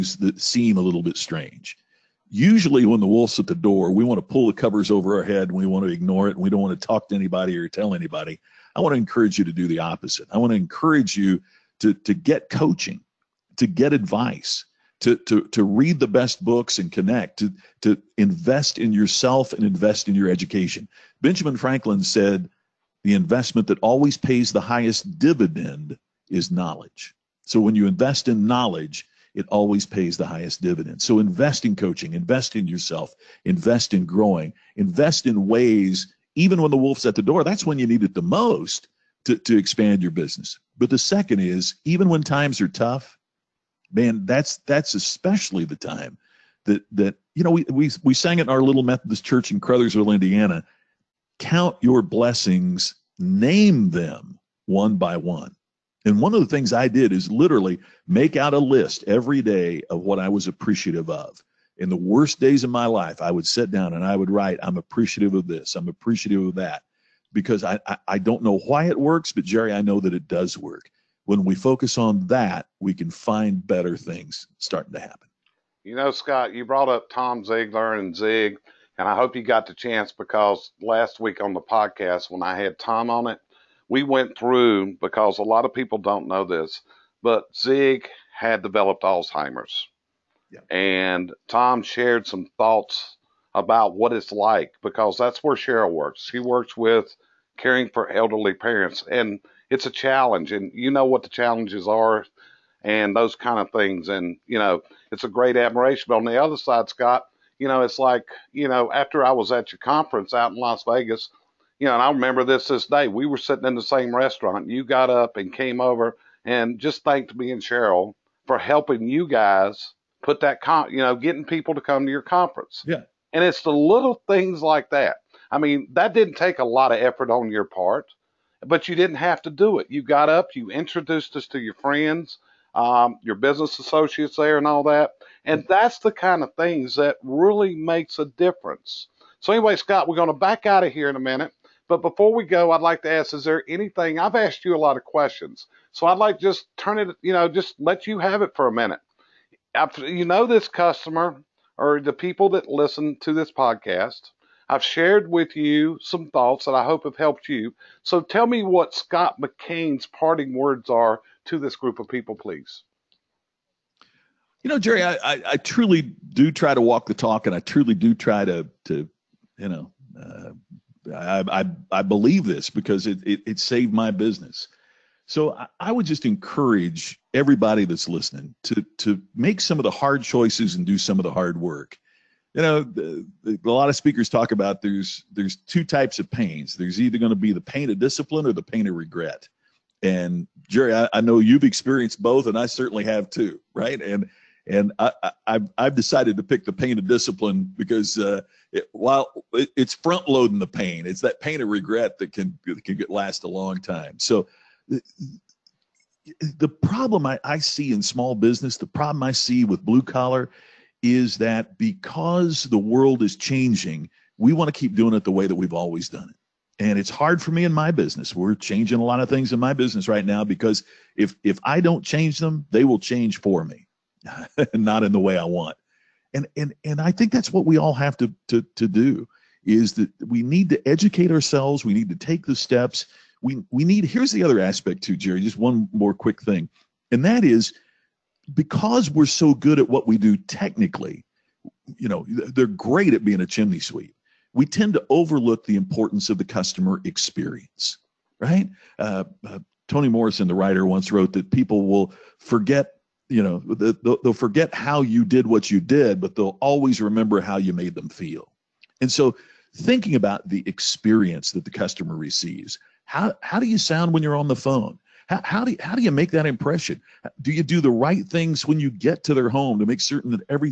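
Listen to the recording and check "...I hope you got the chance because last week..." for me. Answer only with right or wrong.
right.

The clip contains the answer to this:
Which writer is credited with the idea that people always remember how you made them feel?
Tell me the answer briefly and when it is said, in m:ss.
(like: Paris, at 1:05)
Toni Morrison, at 4:09.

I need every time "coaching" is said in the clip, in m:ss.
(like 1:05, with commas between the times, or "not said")
0:12, 0:31.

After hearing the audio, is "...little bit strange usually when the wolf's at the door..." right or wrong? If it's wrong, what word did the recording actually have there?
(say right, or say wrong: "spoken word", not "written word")
right.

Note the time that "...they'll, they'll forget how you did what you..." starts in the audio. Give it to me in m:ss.
4:13.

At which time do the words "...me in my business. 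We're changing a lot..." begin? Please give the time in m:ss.
3:37.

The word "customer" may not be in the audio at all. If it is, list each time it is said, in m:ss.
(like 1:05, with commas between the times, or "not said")
2:30, 4:06, 4:21.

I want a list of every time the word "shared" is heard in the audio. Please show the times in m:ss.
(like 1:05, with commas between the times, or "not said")
1:31, 2:34.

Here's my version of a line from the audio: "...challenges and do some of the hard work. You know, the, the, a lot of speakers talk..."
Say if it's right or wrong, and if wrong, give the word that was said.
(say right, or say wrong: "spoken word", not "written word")
wrong: "choices", not "challenges".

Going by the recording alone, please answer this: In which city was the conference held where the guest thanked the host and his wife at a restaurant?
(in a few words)
Las Vegas.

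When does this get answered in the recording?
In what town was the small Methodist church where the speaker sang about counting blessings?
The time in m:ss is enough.
0:49.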